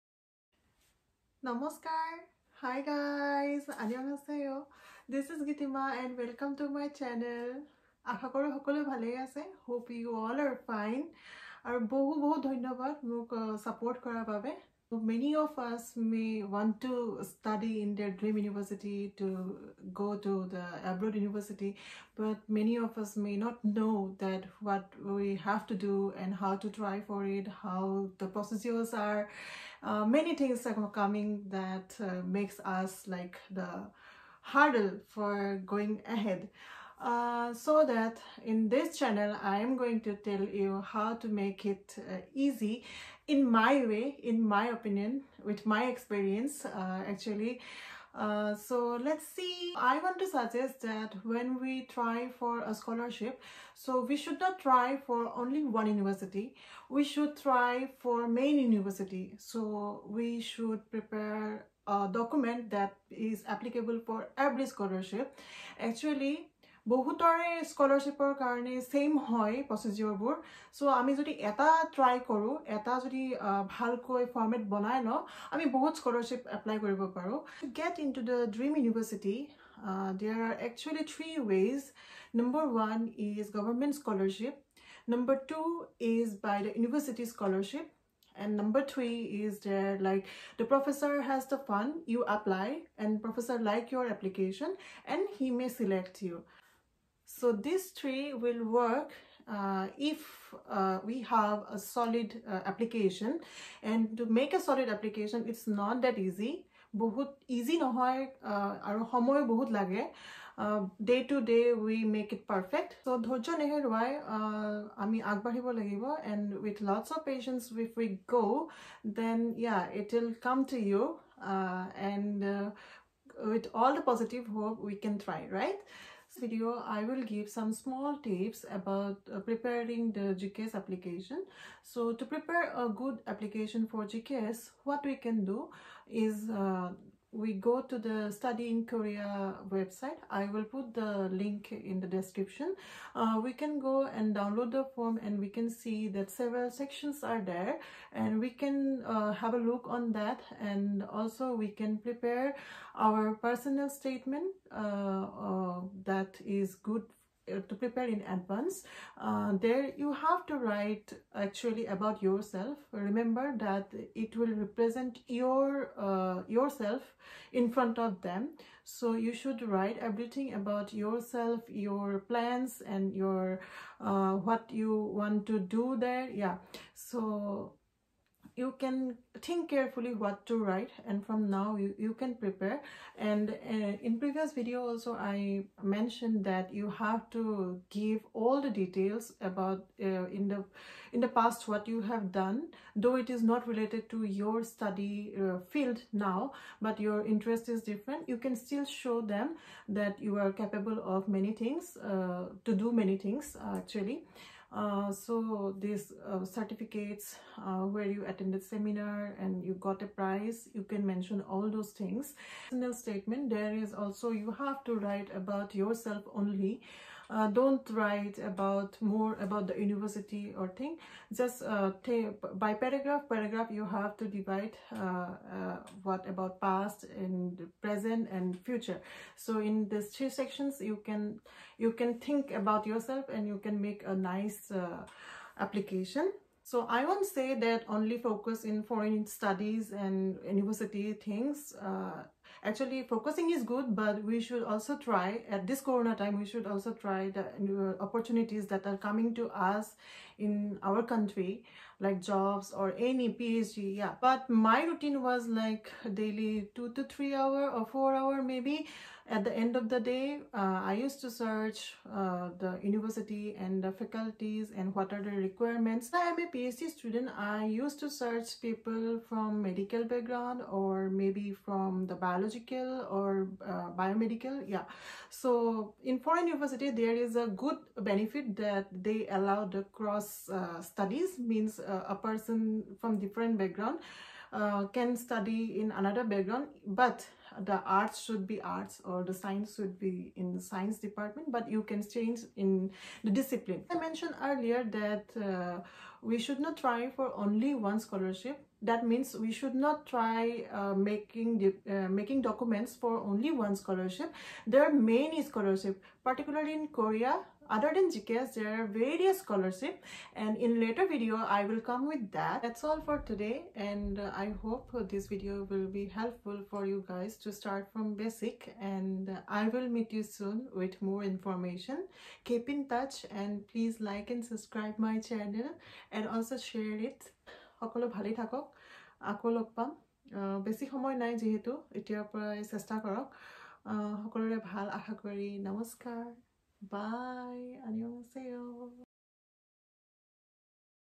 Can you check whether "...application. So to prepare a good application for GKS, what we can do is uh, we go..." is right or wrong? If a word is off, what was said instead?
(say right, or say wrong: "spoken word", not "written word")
right.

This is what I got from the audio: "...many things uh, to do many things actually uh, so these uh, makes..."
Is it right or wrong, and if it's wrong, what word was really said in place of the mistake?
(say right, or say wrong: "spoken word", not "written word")
wrong: "certificates", not "makes".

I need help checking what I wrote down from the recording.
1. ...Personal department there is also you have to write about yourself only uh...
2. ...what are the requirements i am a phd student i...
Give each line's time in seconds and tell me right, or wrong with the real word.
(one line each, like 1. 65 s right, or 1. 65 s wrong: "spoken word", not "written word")
1. 212 s wrong: "statement", not "department"
2. 264 s right.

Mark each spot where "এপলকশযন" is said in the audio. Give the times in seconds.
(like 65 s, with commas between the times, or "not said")
94 s.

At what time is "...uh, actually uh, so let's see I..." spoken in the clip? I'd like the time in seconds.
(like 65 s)
46 s.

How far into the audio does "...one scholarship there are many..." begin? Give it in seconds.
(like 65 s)
303 s.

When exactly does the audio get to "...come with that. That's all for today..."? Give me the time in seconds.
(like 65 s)
311 s.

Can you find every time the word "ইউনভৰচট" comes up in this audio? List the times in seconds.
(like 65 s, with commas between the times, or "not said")
78 s, 86 s.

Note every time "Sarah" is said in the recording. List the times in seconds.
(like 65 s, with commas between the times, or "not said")
not said.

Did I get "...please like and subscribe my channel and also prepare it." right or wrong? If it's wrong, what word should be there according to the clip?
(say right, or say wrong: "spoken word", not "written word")
wrong: "share", not "prepare".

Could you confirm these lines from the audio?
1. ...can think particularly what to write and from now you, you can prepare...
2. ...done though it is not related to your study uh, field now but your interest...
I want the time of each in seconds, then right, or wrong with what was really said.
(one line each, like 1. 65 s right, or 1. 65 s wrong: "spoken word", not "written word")
1. 178 s wrong: "carefully", not "particularly"
2. 192 s right.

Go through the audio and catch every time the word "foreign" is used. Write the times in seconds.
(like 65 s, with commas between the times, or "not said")
238 s, 276 s.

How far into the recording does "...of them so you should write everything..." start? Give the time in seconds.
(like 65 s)
167 s.